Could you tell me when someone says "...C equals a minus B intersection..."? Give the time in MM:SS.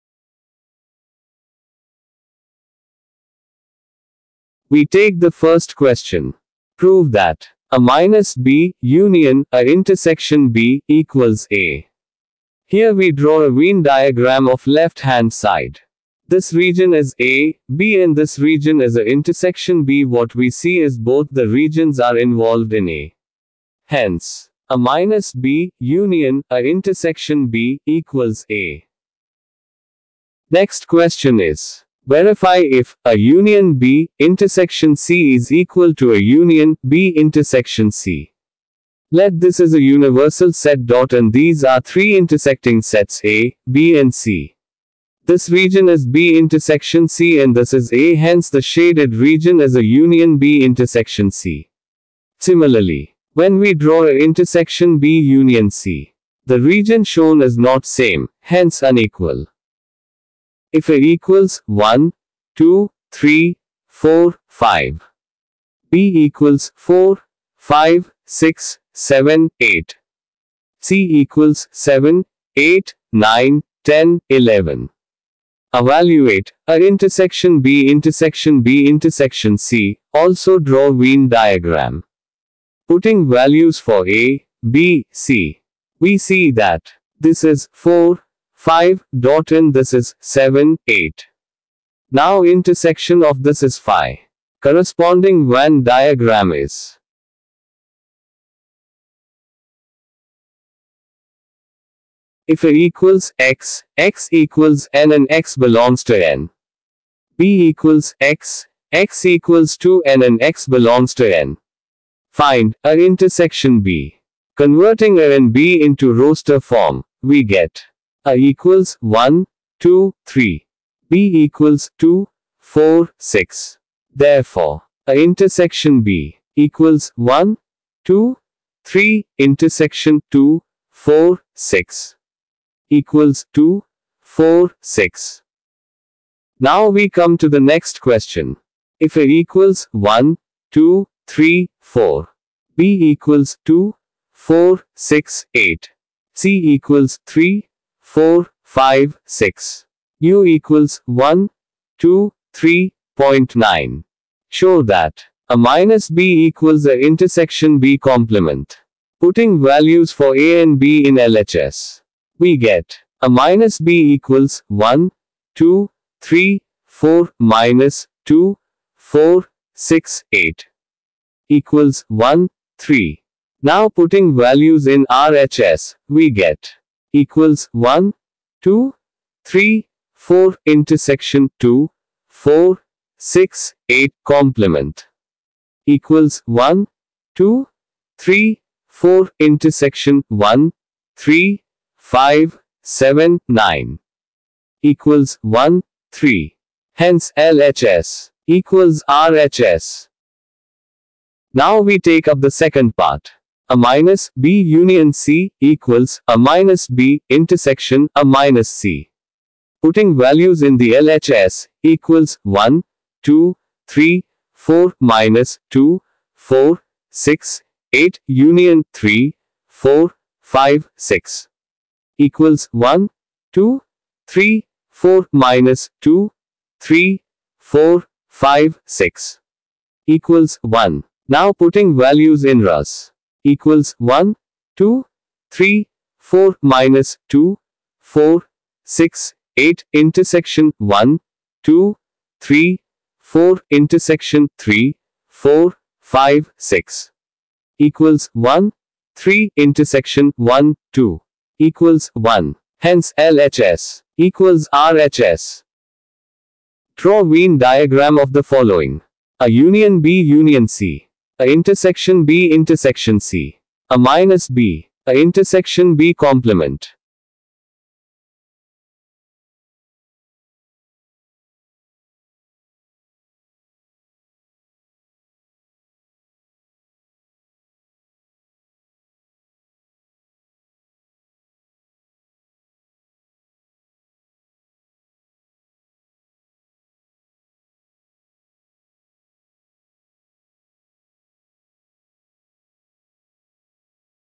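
03:25.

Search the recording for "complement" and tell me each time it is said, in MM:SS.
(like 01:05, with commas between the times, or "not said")
02:37, 03:04, 04:26.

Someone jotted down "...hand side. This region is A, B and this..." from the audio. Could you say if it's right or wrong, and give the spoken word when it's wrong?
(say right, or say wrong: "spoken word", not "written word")
right.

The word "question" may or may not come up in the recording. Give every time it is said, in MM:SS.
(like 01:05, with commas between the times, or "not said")
00:05, 00:30, 02:18.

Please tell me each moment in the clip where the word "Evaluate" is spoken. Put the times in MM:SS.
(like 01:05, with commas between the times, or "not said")
01:15.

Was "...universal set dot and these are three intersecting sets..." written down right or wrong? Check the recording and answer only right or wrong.
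right.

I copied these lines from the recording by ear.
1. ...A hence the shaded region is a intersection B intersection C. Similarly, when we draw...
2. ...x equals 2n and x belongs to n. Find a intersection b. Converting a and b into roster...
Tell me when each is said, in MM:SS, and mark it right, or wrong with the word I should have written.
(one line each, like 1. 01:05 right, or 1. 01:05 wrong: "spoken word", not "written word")
1. 00:47 wrong: "union", not "intersection"
2. 01:48 right.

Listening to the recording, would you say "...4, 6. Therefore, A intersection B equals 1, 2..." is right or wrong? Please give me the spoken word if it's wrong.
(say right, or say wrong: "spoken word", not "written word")
right.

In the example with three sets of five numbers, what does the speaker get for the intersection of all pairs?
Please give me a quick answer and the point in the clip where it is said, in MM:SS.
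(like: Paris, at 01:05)
phi, at 01:33.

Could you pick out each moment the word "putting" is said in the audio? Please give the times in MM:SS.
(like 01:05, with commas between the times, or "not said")
01:22, 02:39, 02:53, 03:29, 03:51.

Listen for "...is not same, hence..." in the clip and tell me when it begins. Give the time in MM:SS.
00:57.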